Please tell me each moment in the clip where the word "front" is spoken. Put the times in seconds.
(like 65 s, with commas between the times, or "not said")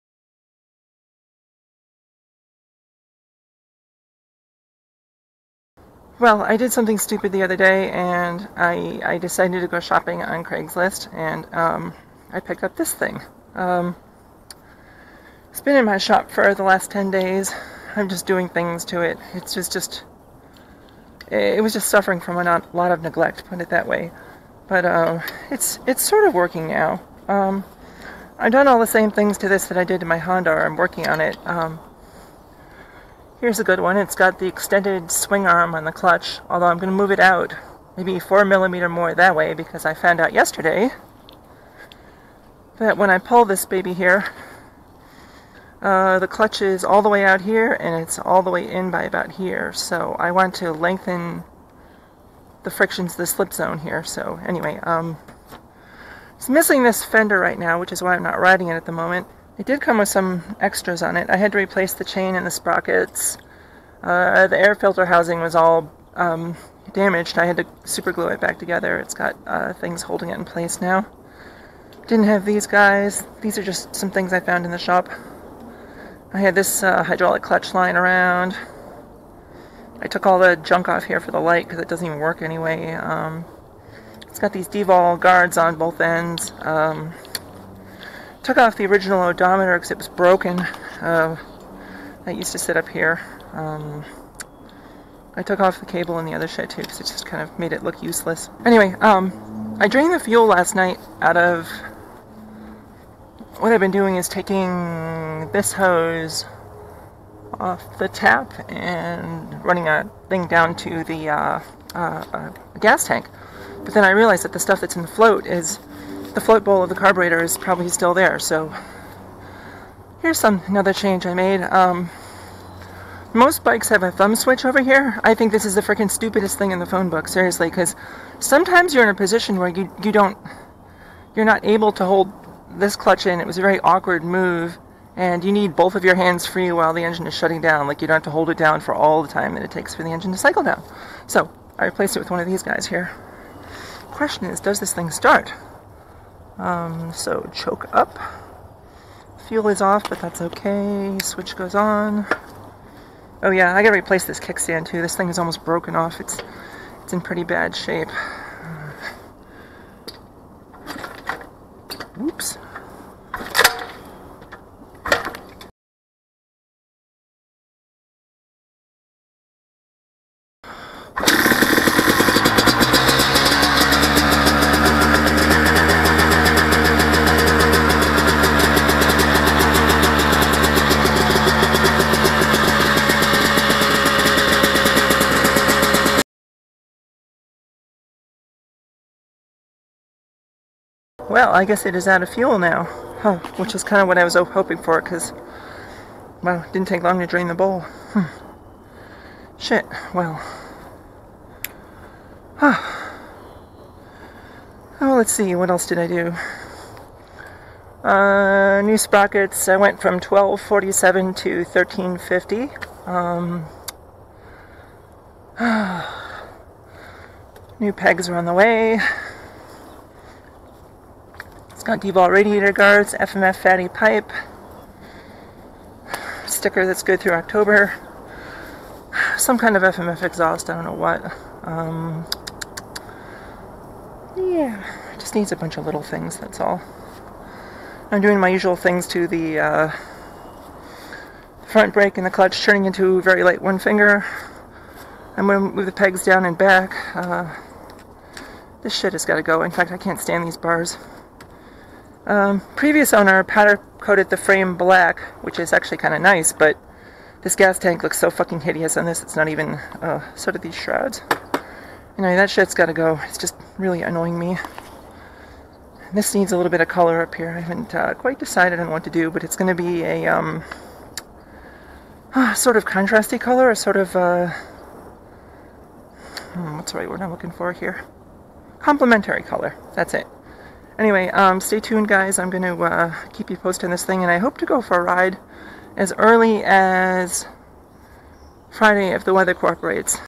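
241 s.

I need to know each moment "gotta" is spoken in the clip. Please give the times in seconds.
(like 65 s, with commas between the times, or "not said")
153 s, 262 s.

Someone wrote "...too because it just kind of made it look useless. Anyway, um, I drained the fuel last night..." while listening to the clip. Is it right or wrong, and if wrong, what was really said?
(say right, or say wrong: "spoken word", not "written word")
right.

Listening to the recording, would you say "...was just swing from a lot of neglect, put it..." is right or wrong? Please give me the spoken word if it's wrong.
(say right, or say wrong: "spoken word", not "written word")
wrong: "suffering", not "swing".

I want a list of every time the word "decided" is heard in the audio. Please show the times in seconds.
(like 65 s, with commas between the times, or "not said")
9 s, 268 s.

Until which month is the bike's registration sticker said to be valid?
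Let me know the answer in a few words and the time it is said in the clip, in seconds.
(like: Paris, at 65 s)
October, at 227 s.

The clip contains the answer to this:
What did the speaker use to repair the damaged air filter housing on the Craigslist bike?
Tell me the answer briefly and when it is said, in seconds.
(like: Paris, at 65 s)
Super glue, at 67 s.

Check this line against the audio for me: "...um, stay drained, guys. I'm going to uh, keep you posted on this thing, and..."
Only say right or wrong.
wrong.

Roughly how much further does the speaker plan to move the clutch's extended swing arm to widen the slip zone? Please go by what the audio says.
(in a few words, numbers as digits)
4 millimeters.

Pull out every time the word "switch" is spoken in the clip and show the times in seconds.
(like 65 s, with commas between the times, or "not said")
124 s, 151 s.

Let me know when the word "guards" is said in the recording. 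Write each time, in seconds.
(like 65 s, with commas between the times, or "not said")
85 s, 222 s.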